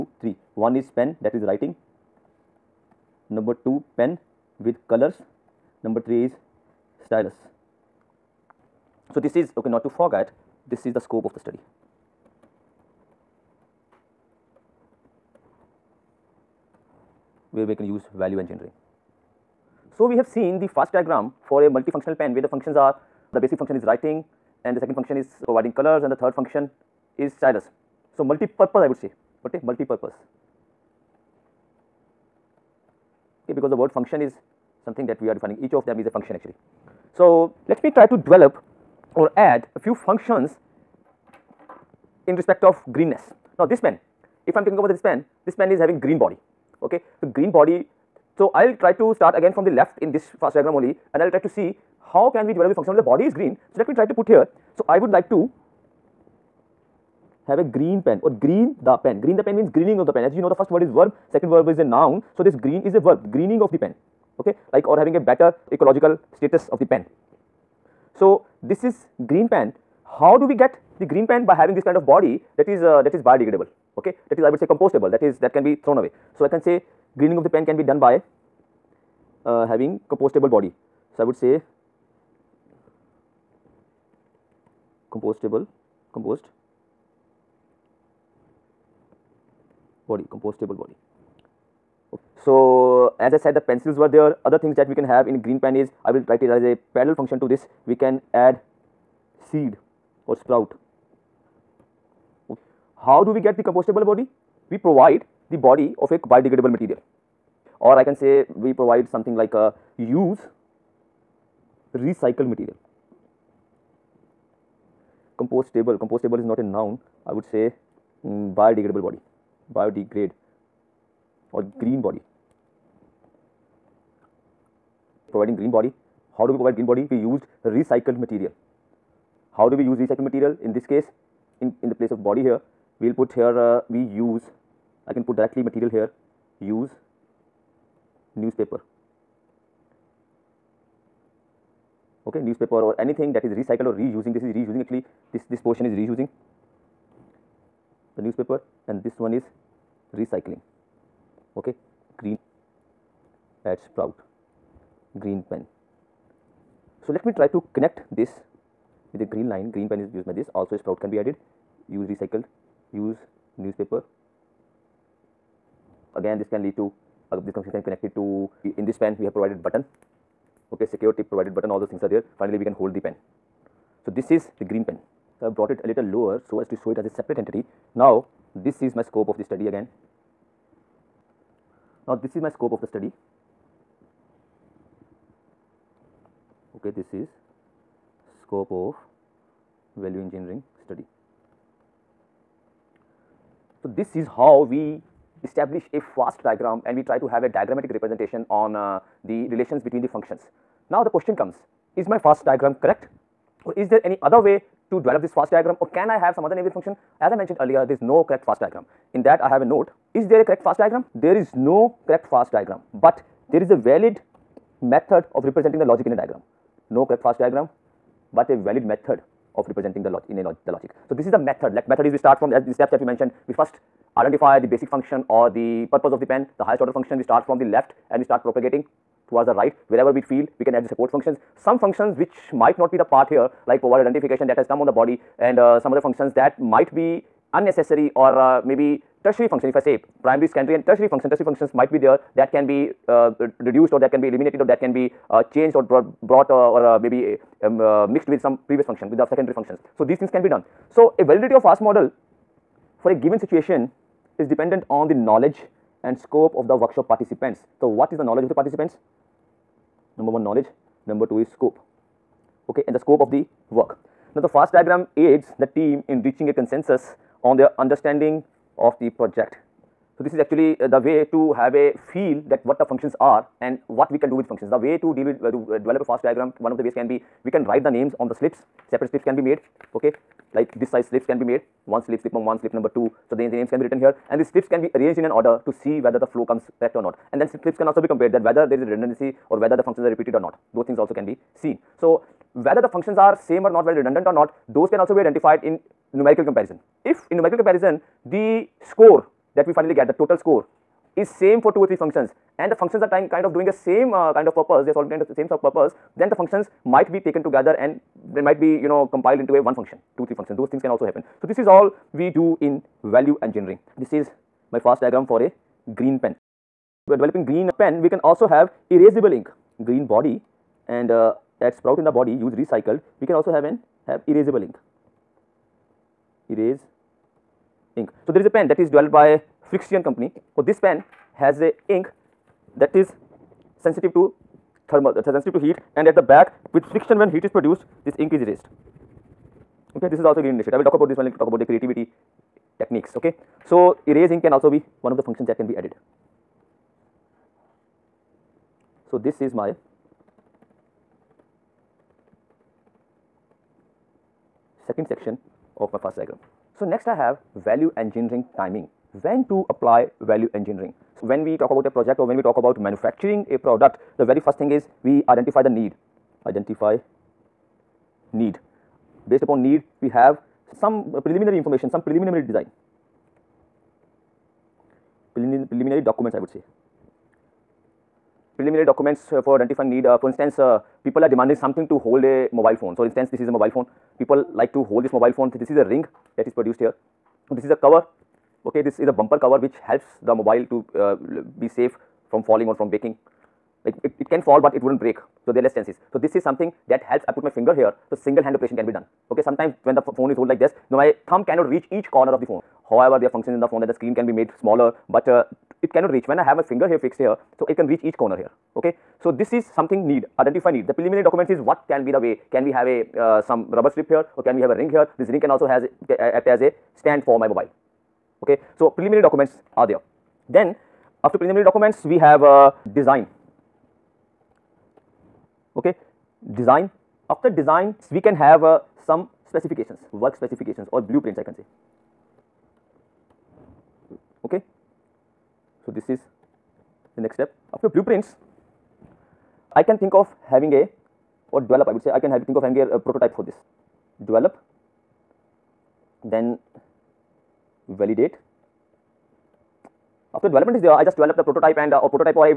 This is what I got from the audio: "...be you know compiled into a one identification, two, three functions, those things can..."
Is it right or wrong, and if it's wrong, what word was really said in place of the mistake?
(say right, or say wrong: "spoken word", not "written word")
wrong: "function", not "identification".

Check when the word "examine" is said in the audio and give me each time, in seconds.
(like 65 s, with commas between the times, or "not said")
not said.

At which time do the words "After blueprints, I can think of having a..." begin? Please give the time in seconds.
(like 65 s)
437 s.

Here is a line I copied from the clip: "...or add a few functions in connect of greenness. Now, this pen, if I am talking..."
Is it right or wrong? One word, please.
wrong.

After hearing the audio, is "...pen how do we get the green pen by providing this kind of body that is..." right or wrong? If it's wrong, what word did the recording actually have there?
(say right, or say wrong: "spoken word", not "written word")
wrong: "having", not "providing".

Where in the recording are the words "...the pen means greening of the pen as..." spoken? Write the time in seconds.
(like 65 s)
59 s.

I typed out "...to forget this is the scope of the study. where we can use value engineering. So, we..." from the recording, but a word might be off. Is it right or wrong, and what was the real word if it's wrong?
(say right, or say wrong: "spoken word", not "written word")
right.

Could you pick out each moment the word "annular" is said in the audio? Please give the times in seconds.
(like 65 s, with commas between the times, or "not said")
not said.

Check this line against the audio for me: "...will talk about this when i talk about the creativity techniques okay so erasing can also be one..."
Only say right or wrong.
right.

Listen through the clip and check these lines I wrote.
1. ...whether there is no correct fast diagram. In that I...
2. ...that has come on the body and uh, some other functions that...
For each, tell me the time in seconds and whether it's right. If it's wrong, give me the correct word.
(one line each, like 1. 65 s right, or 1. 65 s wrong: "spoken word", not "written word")
1. 207 s wrong: "earlier", not "whether"
2. 234 s right.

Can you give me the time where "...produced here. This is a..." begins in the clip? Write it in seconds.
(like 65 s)
386 s.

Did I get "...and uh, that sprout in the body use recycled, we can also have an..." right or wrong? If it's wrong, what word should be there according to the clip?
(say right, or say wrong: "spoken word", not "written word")
right.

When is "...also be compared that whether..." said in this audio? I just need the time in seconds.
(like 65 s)
287 s.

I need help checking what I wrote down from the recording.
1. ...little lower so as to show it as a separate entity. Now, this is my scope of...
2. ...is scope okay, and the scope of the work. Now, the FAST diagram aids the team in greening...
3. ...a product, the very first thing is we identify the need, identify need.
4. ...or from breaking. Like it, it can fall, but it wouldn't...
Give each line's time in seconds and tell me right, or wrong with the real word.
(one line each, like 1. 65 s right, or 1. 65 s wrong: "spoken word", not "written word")
1. 175 s right
2. 261 s wrong: "reaching", not "greening"
3. 363 s right
4. 392 s right.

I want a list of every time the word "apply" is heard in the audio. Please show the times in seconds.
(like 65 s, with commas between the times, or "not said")
359 s.